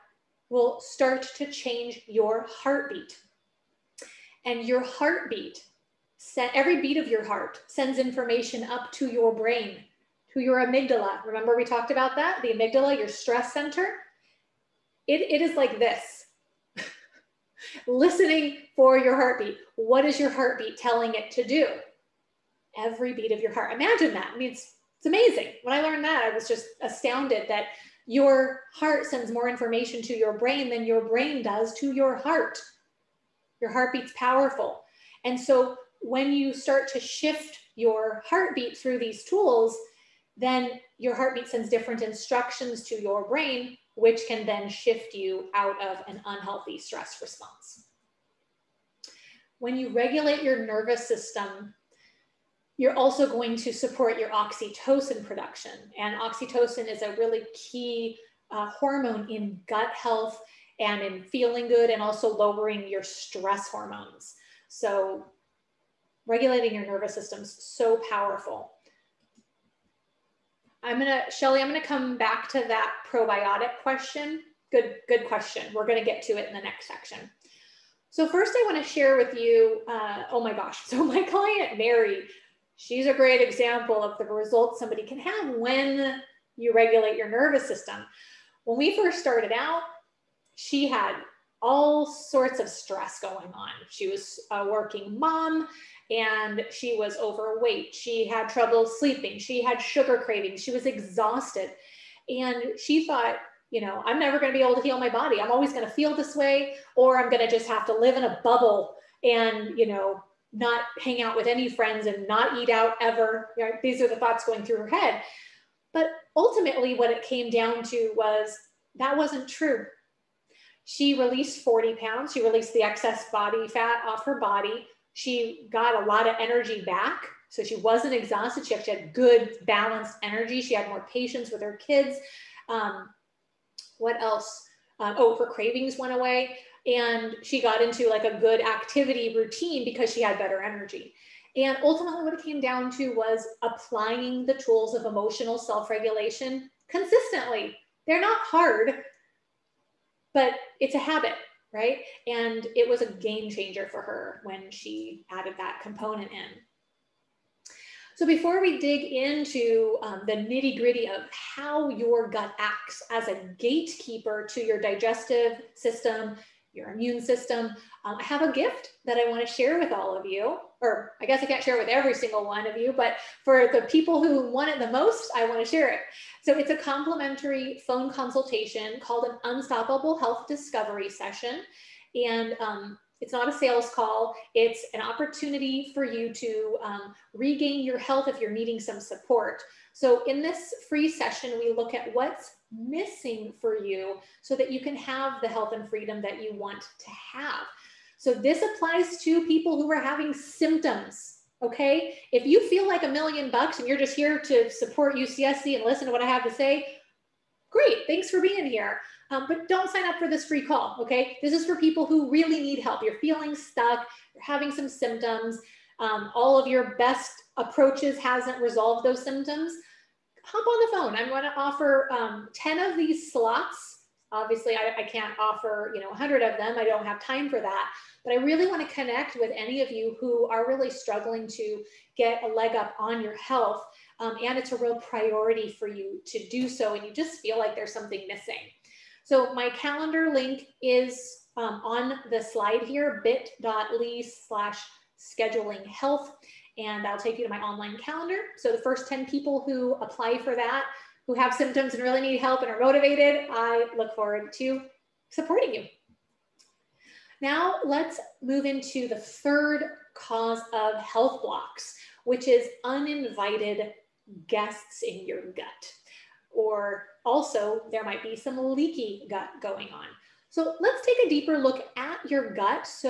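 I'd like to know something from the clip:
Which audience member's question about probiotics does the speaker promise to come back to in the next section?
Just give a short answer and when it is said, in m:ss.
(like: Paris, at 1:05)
Shelly, at 1:11.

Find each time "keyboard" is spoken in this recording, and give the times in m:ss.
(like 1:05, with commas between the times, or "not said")
not said.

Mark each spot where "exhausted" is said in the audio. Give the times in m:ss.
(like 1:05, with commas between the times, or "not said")
1:40, 2:08.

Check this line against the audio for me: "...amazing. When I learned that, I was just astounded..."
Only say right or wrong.
right.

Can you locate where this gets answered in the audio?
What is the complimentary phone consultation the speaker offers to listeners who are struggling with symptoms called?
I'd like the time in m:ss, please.
2:59.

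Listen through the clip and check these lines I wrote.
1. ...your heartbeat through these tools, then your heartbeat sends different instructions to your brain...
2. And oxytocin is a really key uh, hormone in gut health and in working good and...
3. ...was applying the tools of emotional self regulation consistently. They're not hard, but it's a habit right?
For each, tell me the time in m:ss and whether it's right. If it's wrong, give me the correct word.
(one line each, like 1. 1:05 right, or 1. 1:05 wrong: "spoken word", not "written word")
1. 0:37 right
2. 0:55 wrong: "feeling", not "working"
3. 2:23 right.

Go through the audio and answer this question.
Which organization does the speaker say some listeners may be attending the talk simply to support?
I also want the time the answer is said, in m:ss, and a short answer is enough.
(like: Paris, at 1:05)
UCSC, at 3:25.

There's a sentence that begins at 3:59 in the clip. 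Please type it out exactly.
So my calendar link is um, on the slide here, bit.ly slash scheduling health.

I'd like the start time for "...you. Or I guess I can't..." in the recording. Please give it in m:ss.
2:50.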